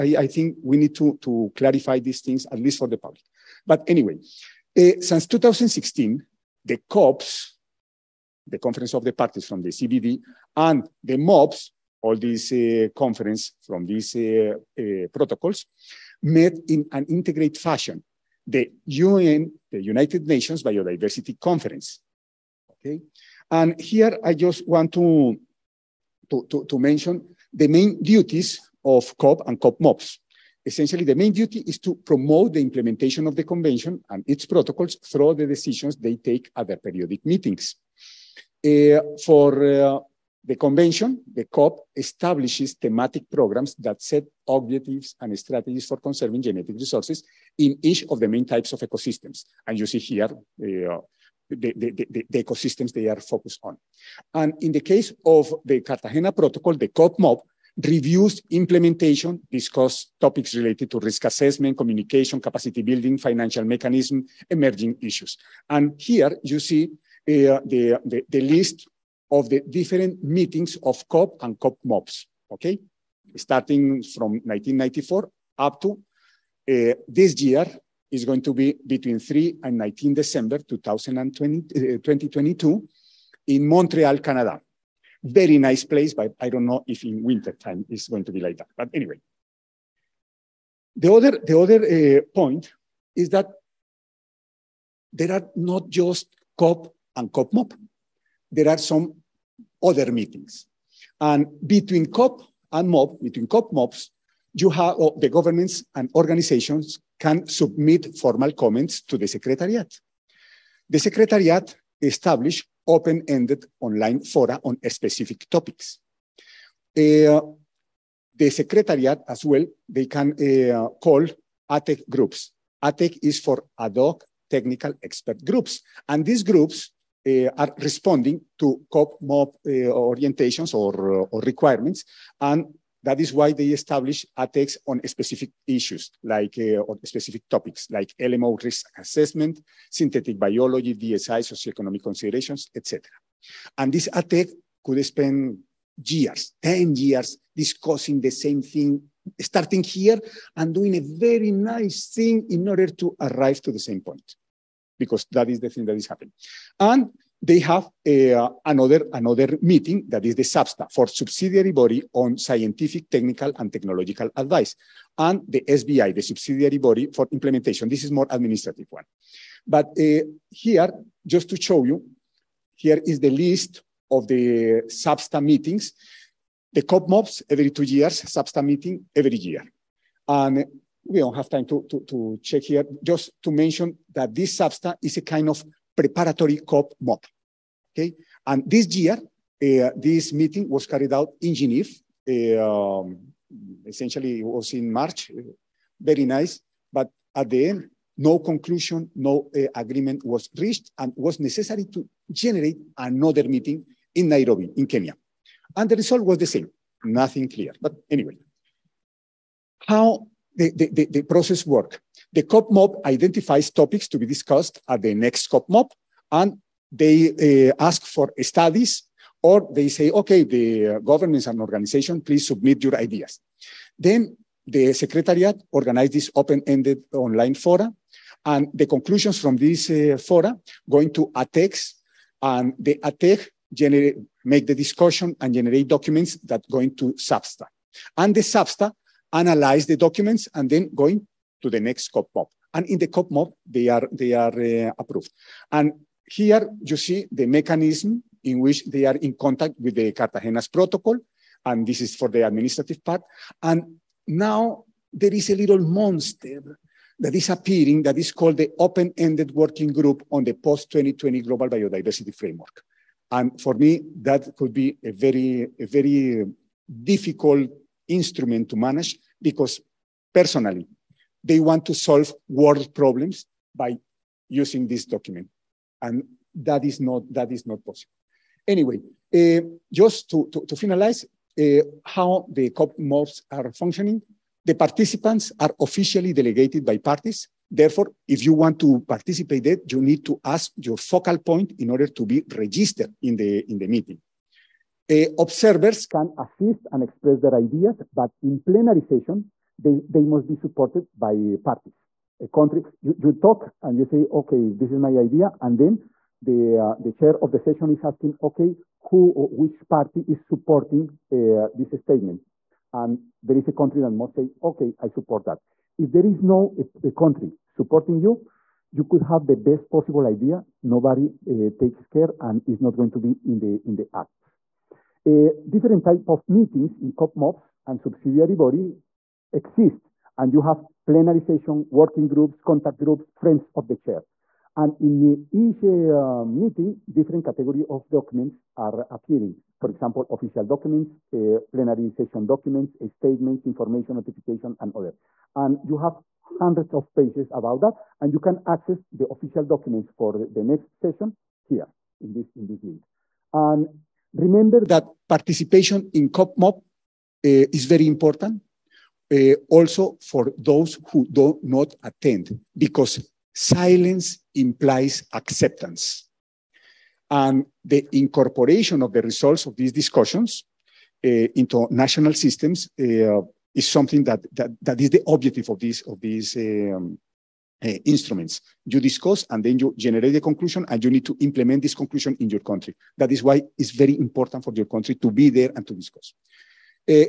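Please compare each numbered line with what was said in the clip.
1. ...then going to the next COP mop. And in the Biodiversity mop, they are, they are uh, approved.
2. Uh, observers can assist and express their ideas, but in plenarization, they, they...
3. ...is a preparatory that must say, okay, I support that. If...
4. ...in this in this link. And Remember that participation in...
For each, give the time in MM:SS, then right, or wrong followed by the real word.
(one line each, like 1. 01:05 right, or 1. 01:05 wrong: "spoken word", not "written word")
1. 04:00 wrong: "COP", not "Biodiversity"
2. 04:55 right
3. 05:13 wrong: "country", not "preparatory"
4. 05:52 right.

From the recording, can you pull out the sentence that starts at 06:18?
You discuss and then you generate a conclusion and you need to implement this conclusion in your country.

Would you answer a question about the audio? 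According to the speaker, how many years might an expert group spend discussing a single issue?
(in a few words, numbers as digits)
10 years.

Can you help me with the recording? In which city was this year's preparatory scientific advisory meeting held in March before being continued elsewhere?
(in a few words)
Geneva.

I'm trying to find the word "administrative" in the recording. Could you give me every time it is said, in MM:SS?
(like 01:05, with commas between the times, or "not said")
02:48, 04:12.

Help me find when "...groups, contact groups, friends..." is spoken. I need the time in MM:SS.
05:32.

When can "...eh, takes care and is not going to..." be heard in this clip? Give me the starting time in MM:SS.
05:21.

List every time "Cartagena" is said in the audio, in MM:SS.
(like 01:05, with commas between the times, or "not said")
00:55, 04:10.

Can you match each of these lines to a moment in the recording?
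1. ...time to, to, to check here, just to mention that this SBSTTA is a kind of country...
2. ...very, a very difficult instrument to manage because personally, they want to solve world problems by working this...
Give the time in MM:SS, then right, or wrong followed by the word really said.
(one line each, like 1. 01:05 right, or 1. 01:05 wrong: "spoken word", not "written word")
1. 03:01 wrong: "preparatory", not "country"
2. 04:25 wrong: "using", not "working".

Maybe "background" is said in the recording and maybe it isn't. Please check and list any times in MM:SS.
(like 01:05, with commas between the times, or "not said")
not said.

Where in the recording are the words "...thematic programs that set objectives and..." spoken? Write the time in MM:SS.
00:42.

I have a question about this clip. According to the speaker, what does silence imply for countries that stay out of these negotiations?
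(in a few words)
acceptance.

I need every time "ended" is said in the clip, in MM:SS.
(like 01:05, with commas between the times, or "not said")
01:52, 03:46, 04:19.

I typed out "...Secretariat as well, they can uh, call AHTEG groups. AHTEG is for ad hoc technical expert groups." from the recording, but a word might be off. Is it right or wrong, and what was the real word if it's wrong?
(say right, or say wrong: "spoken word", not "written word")
right.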